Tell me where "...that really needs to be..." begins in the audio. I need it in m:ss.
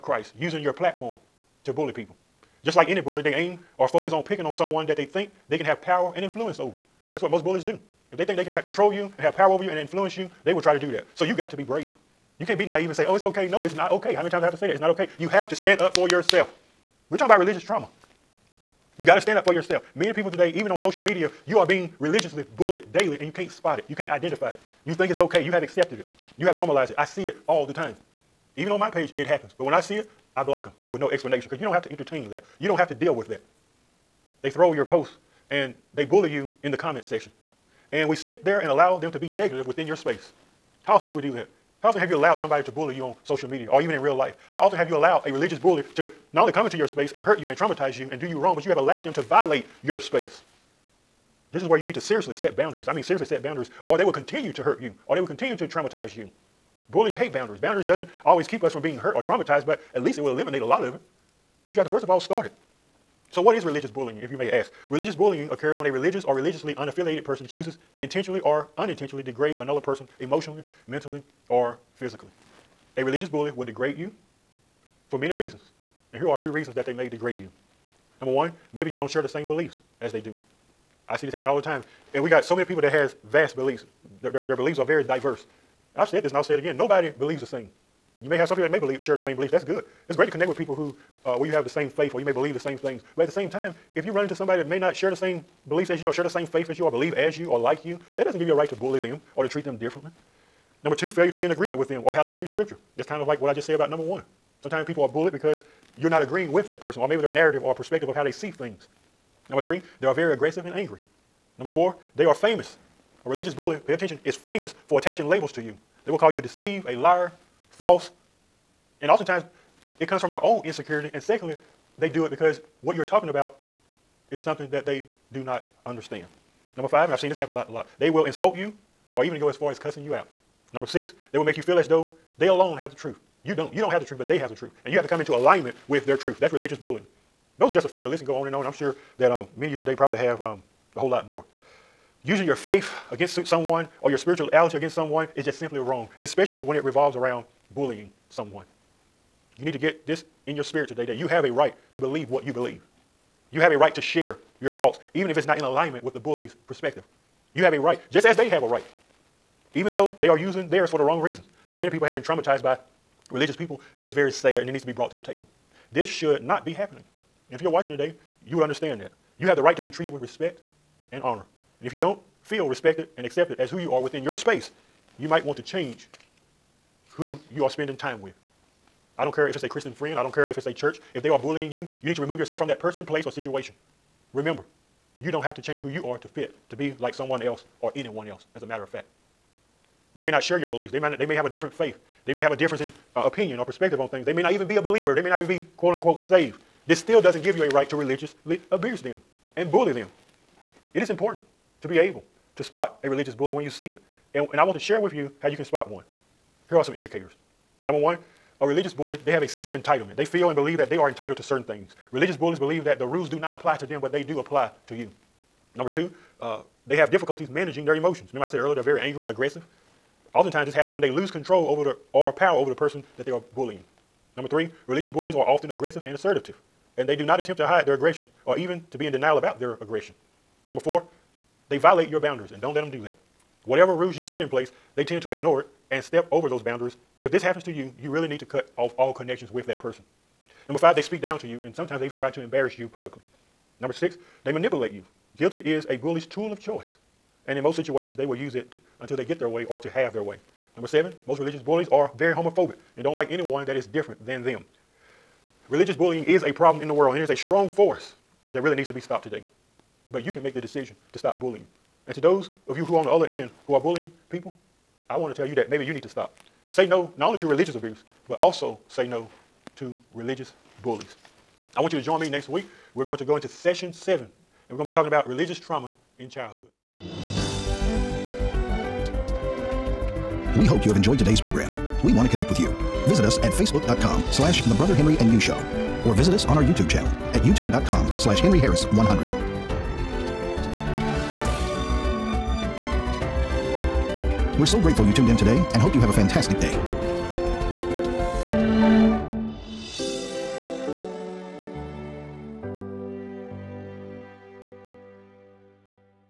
4:18.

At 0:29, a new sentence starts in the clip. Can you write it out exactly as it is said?
But when I see it, I block them with no explanation because you don't have to entertain that.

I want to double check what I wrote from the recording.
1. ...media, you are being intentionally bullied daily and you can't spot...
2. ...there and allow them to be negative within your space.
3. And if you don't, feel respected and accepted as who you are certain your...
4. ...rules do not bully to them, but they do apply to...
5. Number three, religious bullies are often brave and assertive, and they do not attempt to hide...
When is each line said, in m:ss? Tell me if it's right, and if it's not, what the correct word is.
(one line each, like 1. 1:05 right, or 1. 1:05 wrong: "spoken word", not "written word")
1. 0:21 wrong: "religiously", not "intentionally"
2. 0:38 right
3. 2:51 wrong: "within", not "certain"
4. 3:33 wrong: "apply", not "bully"
5. 3:44 wrong: "aggressive", not "brave".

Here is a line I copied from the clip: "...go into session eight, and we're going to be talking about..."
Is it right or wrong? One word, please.
wrong.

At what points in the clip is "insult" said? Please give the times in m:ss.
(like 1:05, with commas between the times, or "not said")
2:08.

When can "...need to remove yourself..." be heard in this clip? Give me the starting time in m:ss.
3:02.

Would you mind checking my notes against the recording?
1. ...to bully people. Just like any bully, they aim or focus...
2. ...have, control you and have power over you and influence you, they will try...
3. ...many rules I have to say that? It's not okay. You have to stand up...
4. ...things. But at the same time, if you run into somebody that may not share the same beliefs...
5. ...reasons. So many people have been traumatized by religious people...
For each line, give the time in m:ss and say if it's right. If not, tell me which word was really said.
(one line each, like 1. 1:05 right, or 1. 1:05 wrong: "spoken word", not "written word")
1. 0:01 right
2. 0:08 right
3. 0:14 wrong: "times", not "rules"
4. 1:32 right
5. 2:41 right.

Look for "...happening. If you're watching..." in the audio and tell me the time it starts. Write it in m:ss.
2:46.